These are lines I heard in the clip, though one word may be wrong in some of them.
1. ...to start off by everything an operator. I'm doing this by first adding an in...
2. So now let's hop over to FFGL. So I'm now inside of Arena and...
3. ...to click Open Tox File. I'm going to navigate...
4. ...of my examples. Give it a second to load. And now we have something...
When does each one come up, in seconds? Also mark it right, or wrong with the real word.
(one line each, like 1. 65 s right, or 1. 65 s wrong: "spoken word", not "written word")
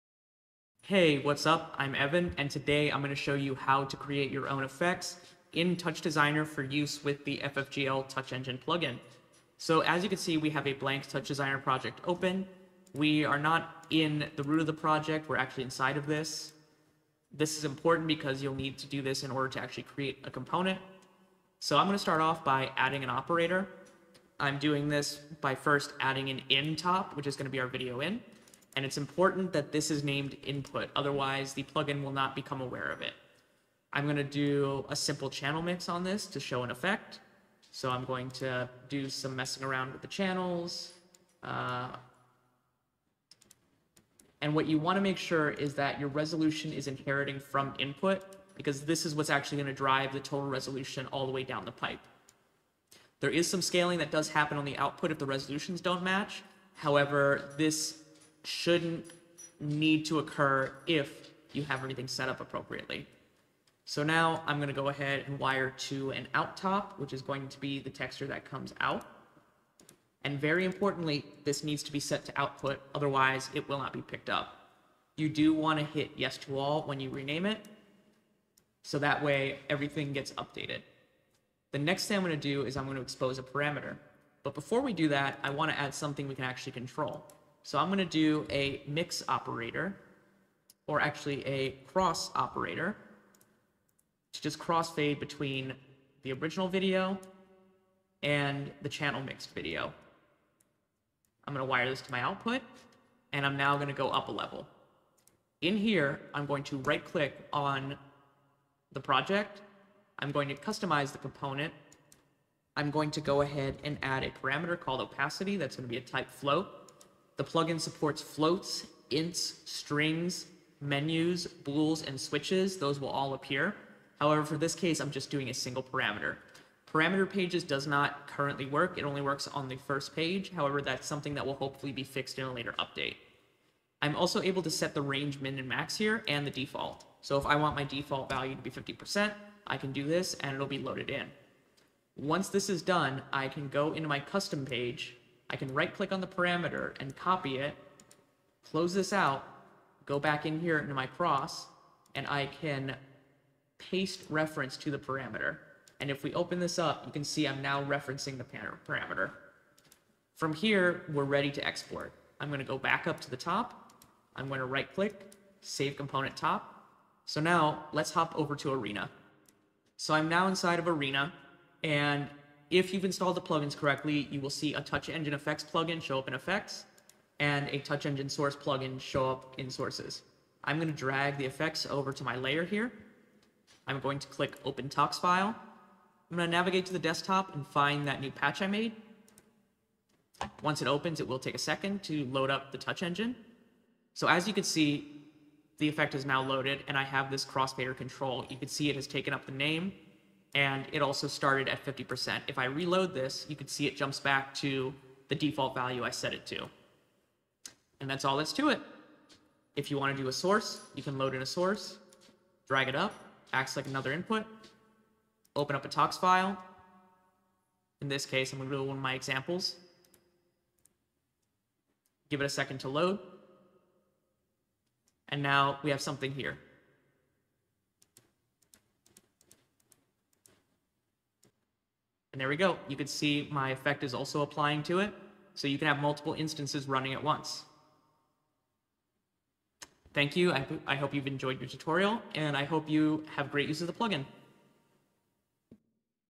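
1. 21 s wrong: "adding", not "everything"
2. 167 s wrong: "Arena", not "FFGL"
3. 184 s right
4. 218 s right.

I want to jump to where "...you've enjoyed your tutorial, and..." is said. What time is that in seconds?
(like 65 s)
241 s.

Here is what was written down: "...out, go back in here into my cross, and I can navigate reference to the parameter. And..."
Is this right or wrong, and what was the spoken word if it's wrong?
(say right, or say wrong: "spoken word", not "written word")
wrong: "paste", not "navigate".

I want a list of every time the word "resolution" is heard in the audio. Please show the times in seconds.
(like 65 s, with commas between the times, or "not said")
46 s, 50 s, 55 s.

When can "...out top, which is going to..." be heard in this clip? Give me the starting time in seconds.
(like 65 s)
66 s.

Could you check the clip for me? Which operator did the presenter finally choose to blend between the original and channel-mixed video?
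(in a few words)
cross operator.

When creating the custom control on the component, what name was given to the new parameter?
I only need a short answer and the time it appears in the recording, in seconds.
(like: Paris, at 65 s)
opacity, at 115 s.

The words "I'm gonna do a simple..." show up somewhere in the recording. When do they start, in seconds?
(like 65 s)
33 s.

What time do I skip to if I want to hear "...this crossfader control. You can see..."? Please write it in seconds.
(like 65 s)
197 s.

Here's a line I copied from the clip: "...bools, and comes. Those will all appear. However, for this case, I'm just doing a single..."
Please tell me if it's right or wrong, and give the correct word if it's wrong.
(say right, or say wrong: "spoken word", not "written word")
wrong: "switches", not "comes".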